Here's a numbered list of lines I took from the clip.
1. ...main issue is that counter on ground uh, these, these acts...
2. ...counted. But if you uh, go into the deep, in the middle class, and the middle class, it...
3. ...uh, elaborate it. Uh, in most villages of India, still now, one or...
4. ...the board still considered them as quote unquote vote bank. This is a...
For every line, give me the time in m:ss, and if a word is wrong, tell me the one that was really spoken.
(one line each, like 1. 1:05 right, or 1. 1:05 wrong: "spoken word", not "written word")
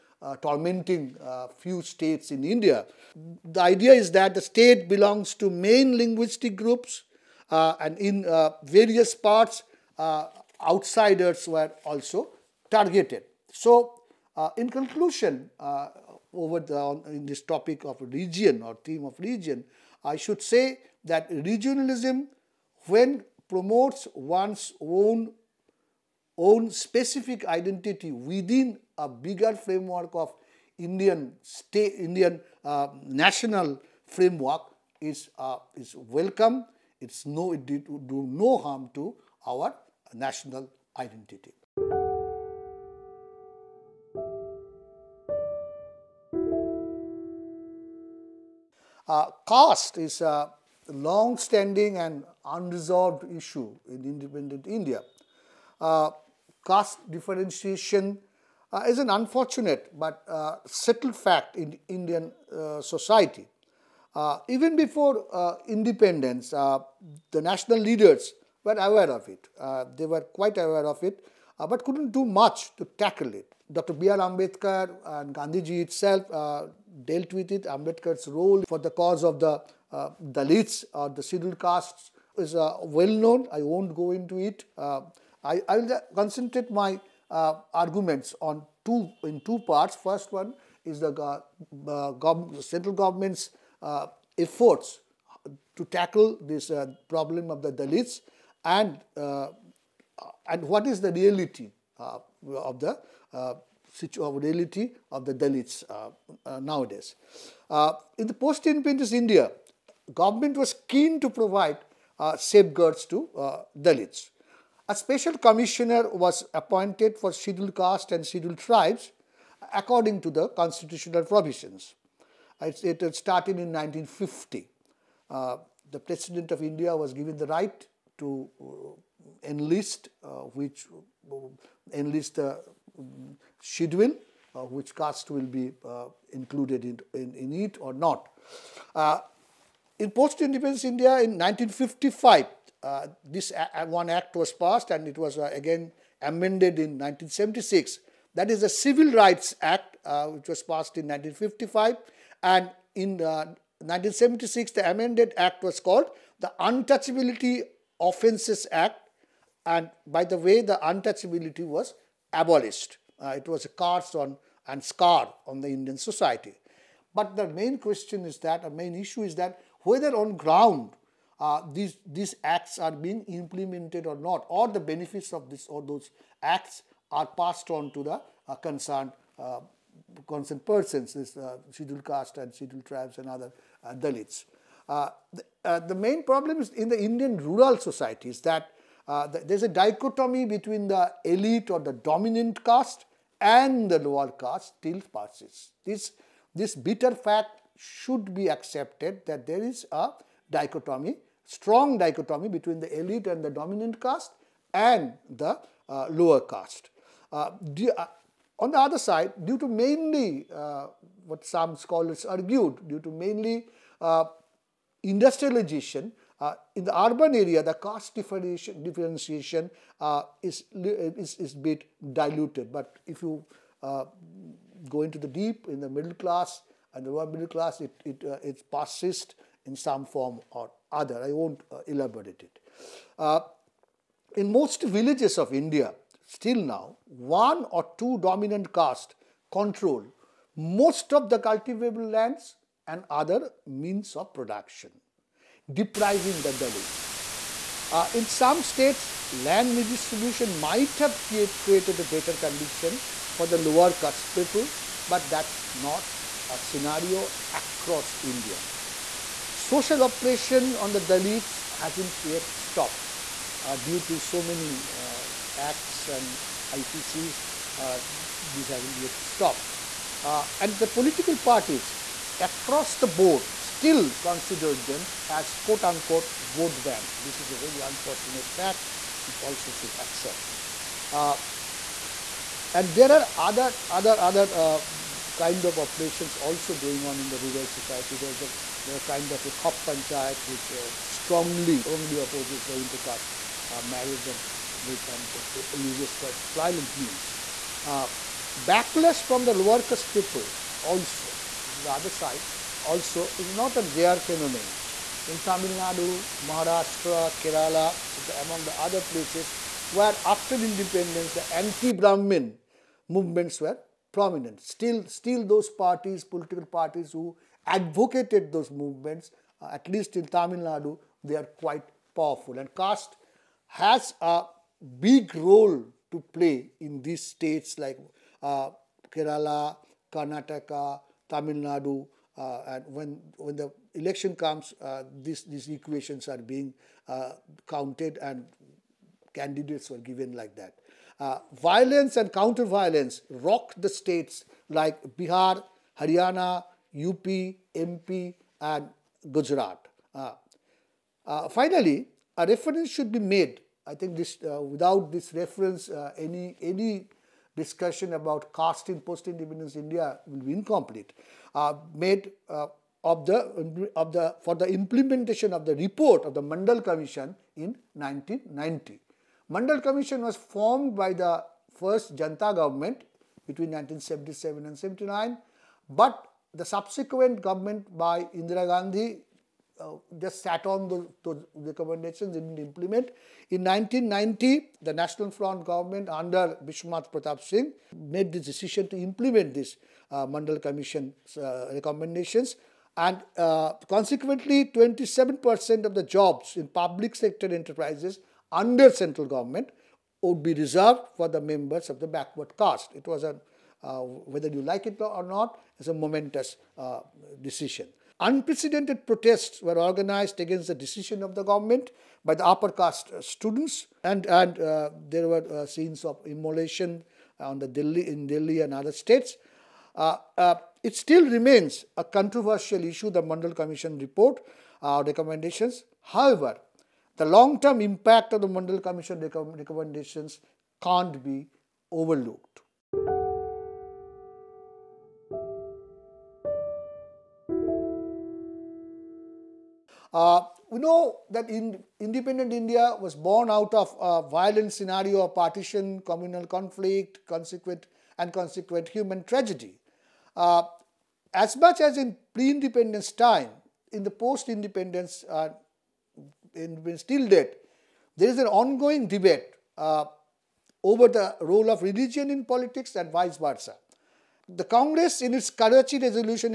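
1. 2:48 wrong: "whether", not "counter"
2. 3:42 wrong: "diluted", not "counted"
3. 3:51 right
4. 4:32 right.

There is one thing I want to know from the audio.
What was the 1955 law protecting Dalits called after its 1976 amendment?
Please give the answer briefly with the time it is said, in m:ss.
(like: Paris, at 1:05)
Untouchability Offences Act, at 2:36.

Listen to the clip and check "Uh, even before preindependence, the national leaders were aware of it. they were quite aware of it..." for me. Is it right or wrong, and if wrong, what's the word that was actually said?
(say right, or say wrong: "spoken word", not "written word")
wrong: "independence", not "preindependence".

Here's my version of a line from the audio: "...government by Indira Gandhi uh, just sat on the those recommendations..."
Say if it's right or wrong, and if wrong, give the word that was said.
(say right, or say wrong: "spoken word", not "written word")
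right.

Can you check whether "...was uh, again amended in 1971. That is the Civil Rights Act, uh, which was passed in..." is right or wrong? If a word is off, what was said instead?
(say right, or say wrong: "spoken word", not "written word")
wrong: "1976", not "1971".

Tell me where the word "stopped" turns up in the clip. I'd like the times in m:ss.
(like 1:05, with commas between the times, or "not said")
4:22, 4:29.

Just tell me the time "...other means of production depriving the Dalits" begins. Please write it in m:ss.
4:03.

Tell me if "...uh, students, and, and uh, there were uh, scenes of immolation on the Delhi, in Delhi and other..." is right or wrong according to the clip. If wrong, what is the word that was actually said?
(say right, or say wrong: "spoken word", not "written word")
right.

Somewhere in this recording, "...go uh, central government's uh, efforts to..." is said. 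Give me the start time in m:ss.
1:31.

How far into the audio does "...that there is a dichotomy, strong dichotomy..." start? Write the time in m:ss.
3:19.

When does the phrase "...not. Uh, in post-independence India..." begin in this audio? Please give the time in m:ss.
2:17.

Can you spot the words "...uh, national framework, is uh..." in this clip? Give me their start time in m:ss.
0:32.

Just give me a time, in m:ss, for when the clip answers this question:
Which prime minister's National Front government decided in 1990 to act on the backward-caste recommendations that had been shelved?
6:26.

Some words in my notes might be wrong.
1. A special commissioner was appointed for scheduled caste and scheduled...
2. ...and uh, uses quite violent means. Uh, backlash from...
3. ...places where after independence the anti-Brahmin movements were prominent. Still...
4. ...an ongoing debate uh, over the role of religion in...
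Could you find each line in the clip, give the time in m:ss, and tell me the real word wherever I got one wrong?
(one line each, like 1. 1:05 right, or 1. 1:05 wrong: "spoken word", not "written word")
1. 1:54 right
2. 4:55 right
3. 5:09 right
4. 7:38 right.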